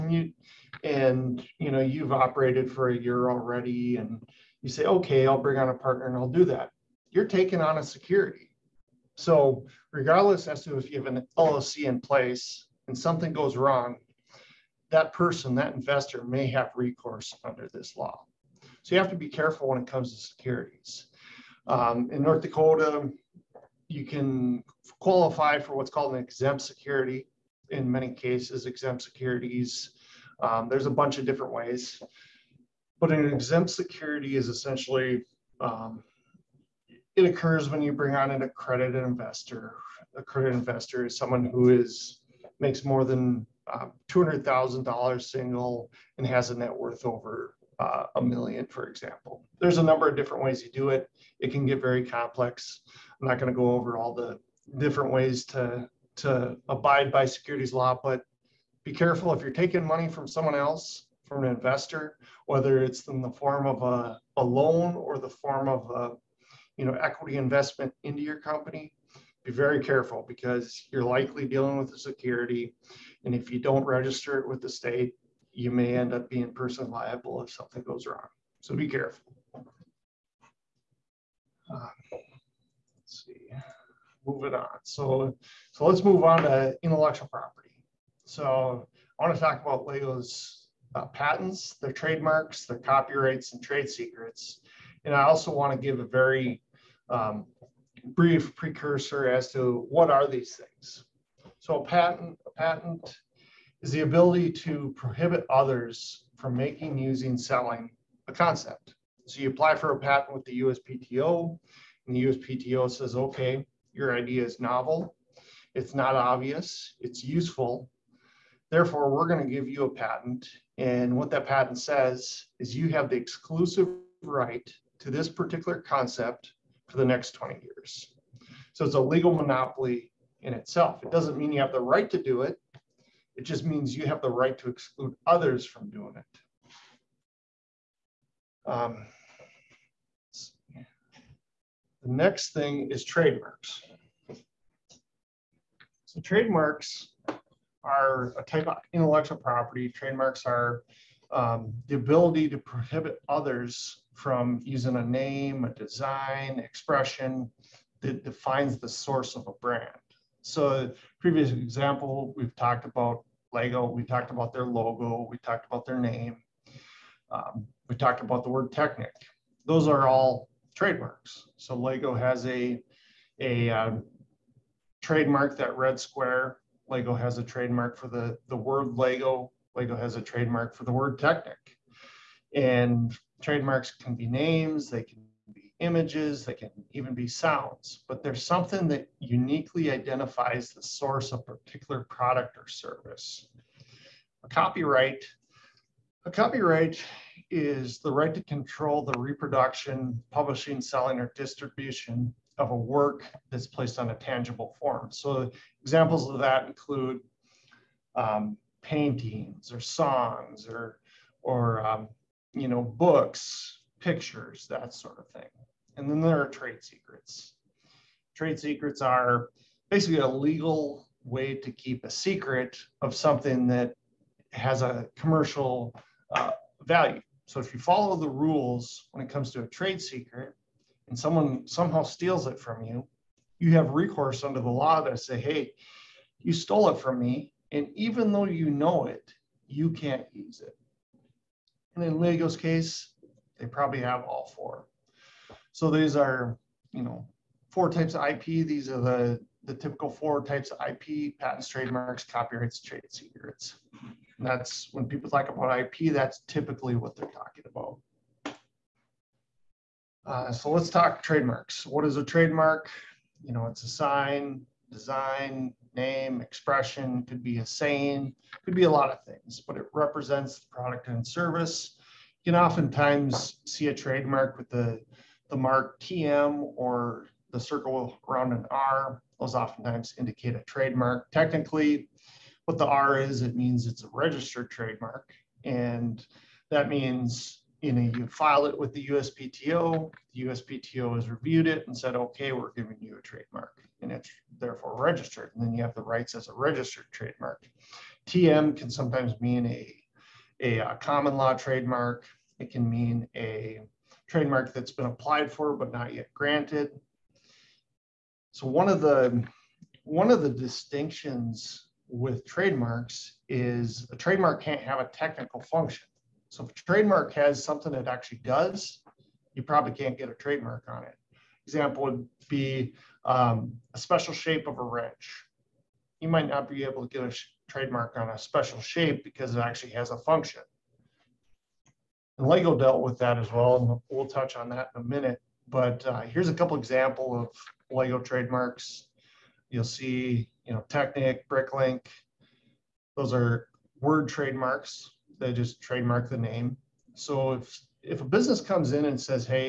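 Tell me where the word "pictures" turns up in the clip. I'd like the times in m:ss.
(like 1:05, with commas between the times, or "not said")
3:33.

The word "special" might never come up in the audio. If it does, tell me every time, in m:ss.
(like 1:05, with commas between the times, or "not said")
5:23, 5:28.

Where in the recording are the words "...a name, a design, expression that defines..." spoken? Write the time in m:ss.
2:34.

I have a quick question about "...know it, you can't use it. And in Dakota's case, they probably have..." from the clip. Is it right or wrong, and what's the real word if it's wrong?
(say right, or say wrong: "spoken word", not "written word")
wrong: "Lego", not "Dakota".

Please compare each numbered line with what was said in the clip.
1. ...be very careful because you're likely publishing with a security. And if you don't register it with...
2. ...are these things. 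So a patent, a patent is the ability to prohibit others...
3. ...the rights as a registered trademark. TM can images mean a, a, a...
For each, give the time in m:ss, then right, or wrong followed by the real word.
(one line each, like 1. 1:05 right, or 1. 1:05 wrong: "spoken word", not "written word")
1. 1:09 wrong: "dealing", not "publishing"
2. 1:40 right
3. 4:55 wrong: "sometimes", not "images".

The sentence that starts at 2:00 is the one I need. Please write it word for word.
And what that patent says is you have the exclusive right to this particular concept for the next 20 years.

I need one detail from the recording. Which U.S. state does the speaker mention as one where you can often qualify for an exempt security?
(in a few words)
North Dakota.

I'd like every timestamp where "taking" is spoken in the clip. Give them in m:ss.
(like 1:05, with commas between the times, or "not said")
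0:07, 0:59.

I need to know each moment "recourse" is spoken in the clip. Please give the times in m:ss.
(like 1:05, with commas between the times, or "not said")
0:16, 3:53.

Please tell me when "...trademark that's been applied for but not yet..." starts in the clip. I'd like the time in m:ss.
5:04.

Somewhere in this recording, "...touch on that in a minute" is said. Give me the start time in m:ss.
5:34.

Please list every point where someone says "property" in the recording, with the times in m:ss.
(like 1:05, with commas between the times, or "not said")
1:27, 2:29.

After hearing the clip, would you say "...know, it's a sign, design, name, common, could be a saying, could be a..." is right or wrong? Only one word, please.
wrong.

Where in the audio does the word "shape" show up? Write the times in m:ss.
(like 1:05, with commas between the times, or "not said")
5:24, 5:28.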